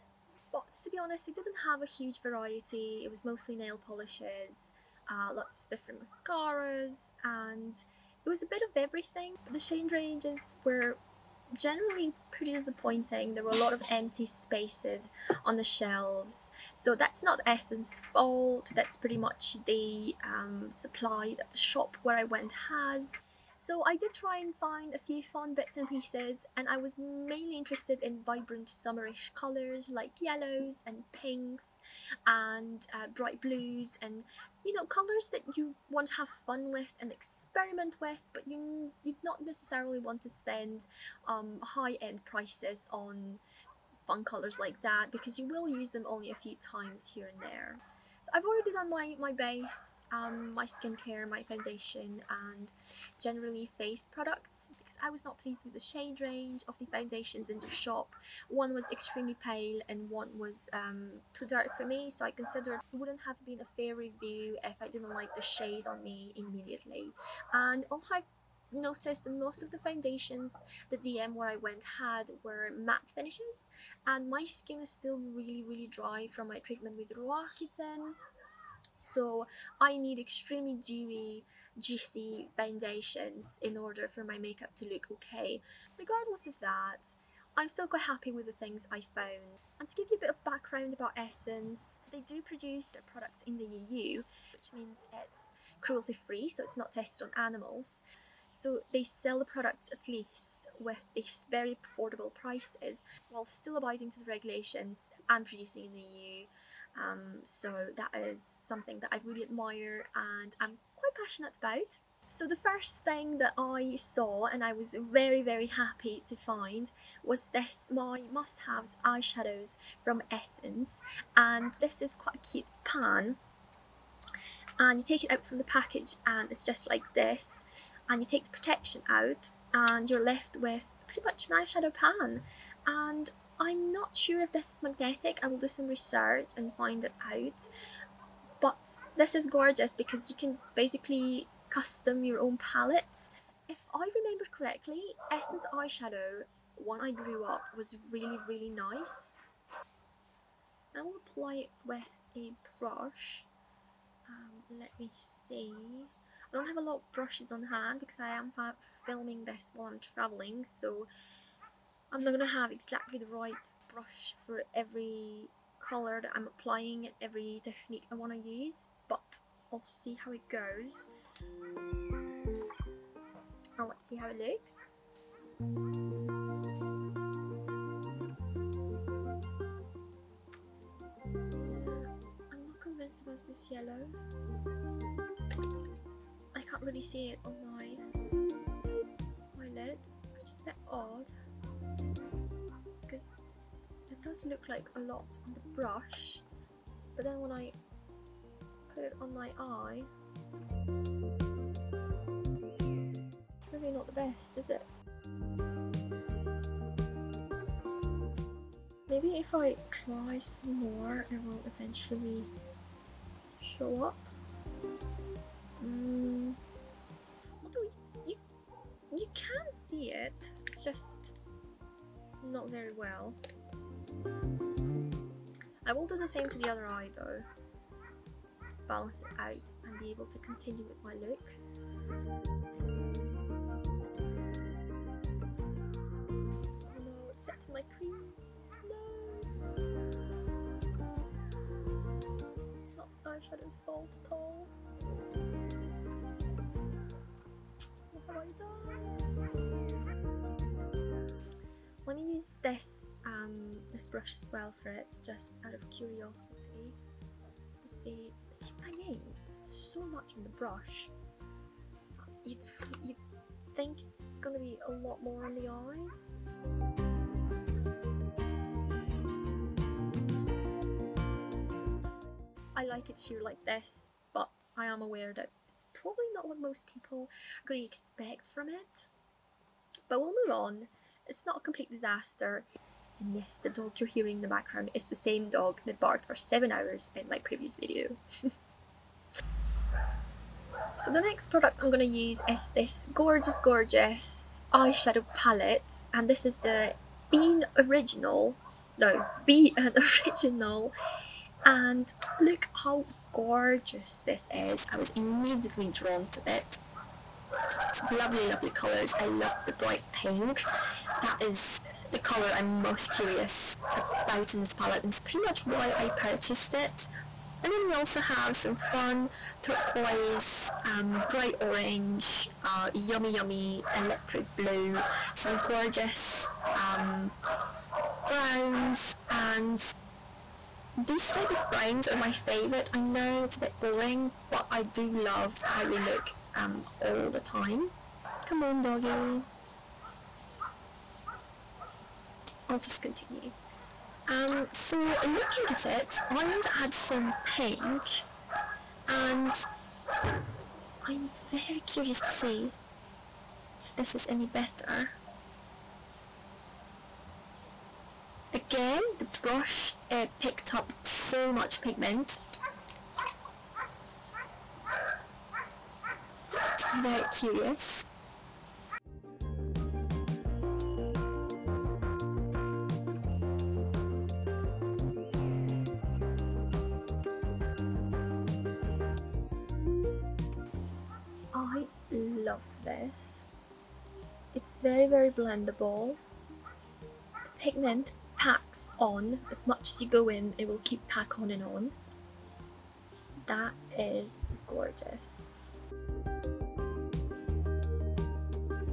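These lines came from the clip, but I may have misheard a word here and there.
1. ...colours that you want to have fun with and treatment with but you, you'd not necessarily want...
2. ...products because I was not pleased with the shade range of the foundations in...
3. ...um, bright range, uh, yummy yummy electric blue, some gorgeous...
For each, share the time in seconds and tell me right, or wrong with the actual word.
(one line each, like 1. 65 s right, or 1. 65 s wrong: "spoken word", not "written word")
1. 34 s wrong: "experiment", not "treatment"
2. 54 s right
3. 320 s wrong: "orange", not "range".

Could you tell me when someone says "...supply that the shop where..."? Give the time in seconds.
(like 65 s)
20 s.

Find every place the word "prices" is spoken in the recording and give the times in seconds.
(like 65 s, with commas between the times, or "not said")
42 s, 102 s.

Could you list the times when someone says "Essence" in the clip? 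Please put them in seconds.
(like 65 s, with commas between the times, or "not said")
17 s, 91 s, 120 s, 145 s.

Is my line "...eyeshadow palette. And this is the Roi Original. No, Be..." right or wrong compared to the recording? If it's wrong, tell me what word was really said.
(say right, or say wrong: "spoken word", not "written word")
wrong: "Bean", not "Roi".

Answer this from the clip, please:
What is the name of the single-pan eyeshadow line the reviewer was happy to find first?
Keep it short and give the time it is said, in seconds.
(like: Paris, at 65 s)
My Must-Haves, at 117 s.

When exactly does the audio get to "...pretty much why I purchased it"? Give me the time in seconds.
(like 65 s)
315 s.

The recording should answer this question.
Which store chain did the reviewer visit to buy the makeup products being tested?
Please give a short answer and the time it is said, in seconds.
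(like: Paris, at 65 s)
DM, at 70 s.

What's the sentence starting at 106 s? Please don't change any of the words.
Um, so that is something that I really admire and I'm quite passionate about.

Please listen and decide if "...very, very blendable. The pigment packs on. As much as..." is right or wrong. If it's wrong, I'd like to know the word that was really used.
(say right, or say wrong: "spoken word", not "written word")
right.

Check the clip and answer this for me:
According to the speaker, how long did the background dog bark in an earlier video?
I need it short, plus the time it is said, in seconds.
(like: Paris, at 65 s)
7 hours, at 286 s.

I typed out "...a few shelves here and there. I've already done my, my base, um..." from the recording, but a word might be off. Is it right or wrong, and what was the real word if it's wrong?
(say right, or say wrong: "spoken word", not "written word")
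wrong: "times", not "shelves".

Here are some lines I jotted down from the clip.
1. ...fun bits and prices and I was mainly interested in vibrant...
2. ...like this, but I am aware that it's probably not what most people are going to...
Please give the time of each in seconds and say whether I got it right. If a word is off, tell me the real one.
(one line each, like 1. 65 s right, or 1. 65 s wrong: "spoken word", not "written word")
1. 25 s wrong: "pieces", not "prices"
2. 273 s right.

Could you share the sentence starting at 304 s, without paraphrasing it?
I was immediately drawn to it.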